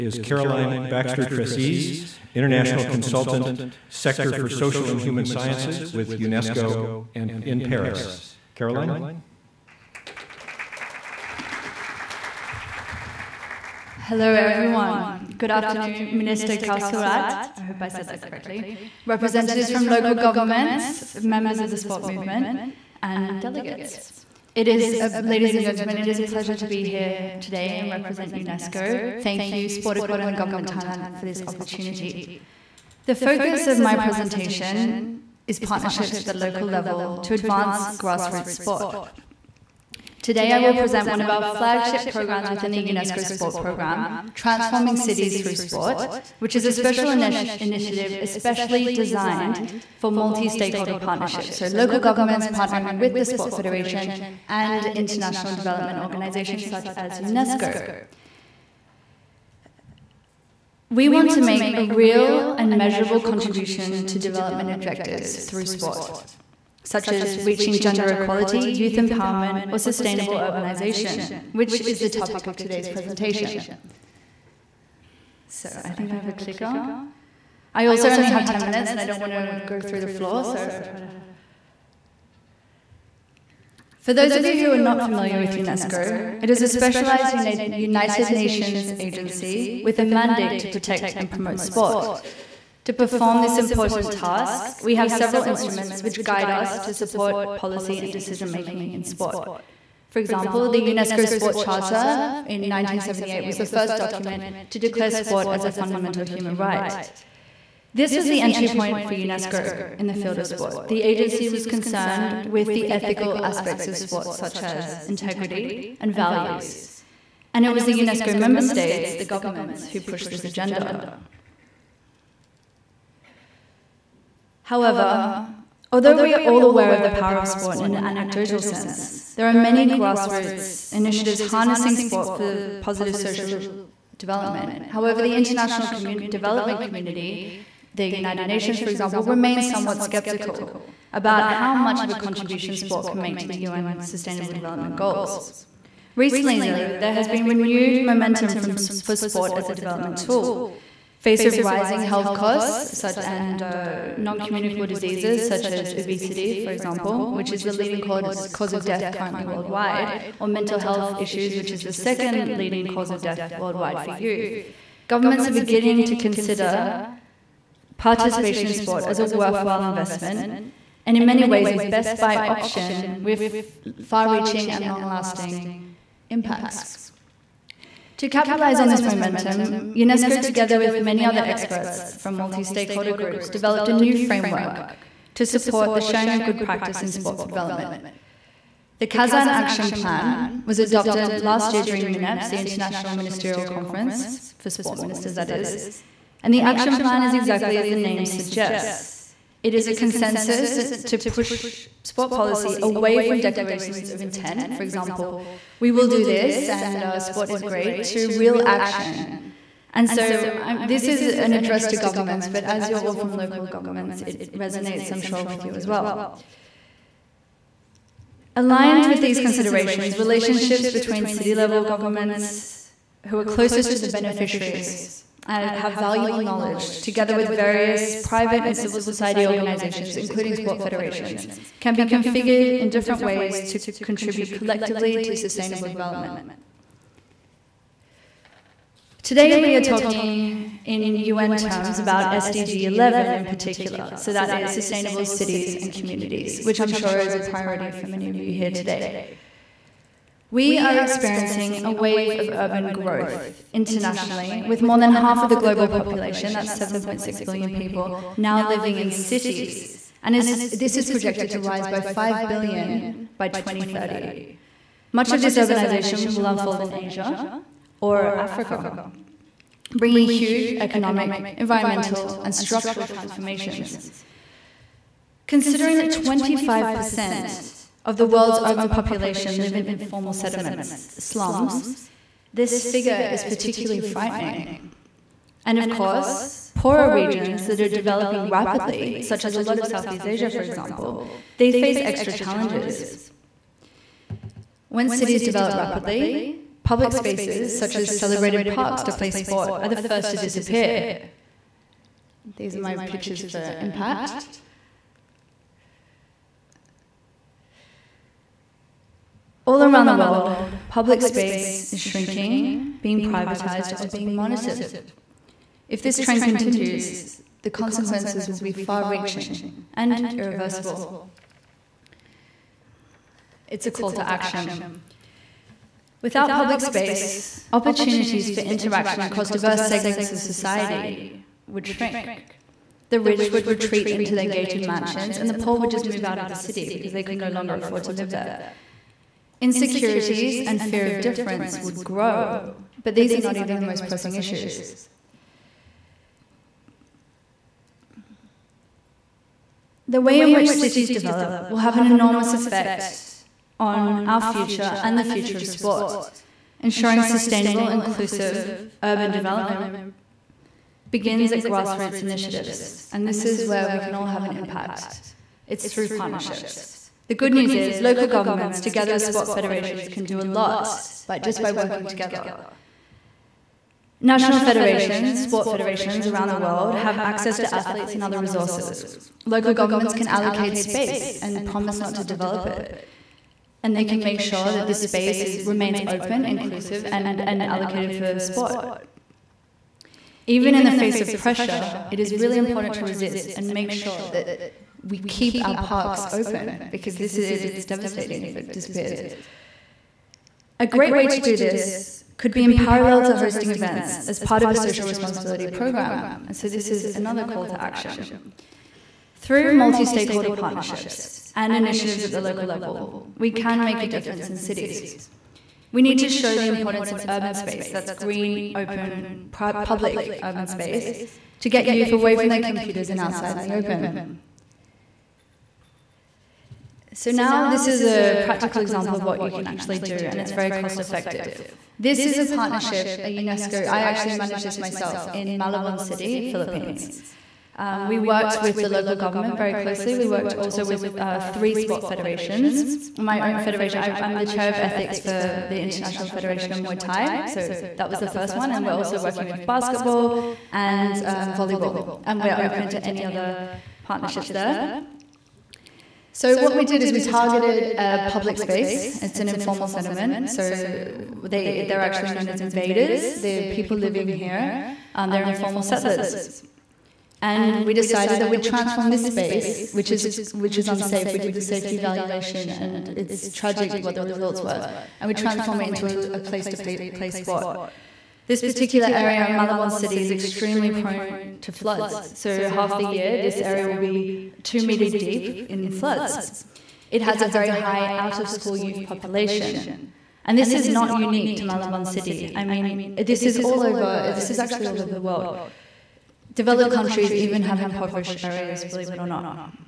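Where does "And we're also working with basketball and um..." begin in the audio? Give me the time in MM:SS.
07:28.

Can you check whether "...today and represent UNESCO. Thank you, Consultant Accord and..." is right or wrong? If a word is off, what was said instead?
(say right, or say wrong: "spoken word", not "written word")
wrong: "Sport", not "Consultant".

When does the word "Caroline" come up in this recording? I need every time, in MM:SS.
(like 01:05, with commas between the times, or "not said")
00:00, 00:08.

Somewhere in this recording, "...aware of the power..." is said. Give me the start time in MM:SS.
02:06.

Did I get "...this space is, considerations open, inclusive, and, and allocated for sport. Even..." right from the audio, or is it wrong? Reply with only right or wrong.
wrong.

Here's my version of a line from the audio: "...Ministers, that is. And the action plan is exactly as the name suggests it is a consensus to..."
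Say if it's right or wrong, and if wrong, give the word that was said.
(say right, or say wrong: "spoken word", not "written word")
right.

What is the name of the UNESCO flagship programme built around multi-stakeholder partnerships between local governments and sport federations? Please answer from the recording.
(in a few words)
Transforming Cities Through Sport.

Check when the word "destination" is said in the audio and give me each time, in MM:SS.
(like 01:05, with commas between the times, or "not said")
not said.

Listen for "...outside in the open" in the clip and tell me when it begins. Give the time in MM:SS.
07:03.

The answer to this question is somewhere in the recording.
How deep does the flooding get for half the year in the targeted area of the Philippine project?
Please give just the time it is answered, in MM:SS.
08:04.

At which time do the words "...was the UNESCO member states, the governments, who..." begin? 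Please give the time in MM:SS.
01:57.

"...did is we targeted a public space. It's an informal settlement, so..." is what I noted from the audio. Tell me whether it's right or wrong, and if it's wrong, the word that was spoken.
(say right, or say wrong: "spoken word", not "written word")
right.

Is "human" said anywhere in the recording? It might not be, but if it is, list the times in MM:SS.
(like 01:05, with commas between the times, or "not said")
00:05, 01:46.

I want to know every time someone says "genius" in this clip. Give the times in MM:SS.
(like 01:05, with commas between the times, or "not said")
not said.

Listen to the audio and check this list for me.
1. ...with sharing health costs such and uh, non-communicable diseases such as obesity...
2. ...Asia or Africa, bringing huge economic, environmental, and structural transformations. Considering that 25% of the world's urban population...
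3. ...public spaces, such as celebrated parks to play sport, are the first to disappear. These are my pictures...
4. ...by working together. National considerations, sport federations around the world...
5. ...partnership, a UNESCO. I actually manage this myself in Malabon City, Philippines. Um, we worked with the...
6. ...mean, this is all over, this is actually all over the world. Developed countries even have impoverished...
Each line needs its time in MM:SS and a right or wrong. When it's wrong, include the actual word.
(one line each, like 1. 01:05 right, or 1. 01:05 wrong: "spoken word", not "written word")
1. 02:31 wrong: "rising", not "sharing"
2. 04:26 right
3. 04:56 right
4. 06:11 wrong: "federations", not "considerations"
5. 07:12 right
6. 08:12 right.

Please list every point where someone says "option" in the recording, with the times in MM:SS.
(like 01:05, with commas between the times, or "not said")
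02:52.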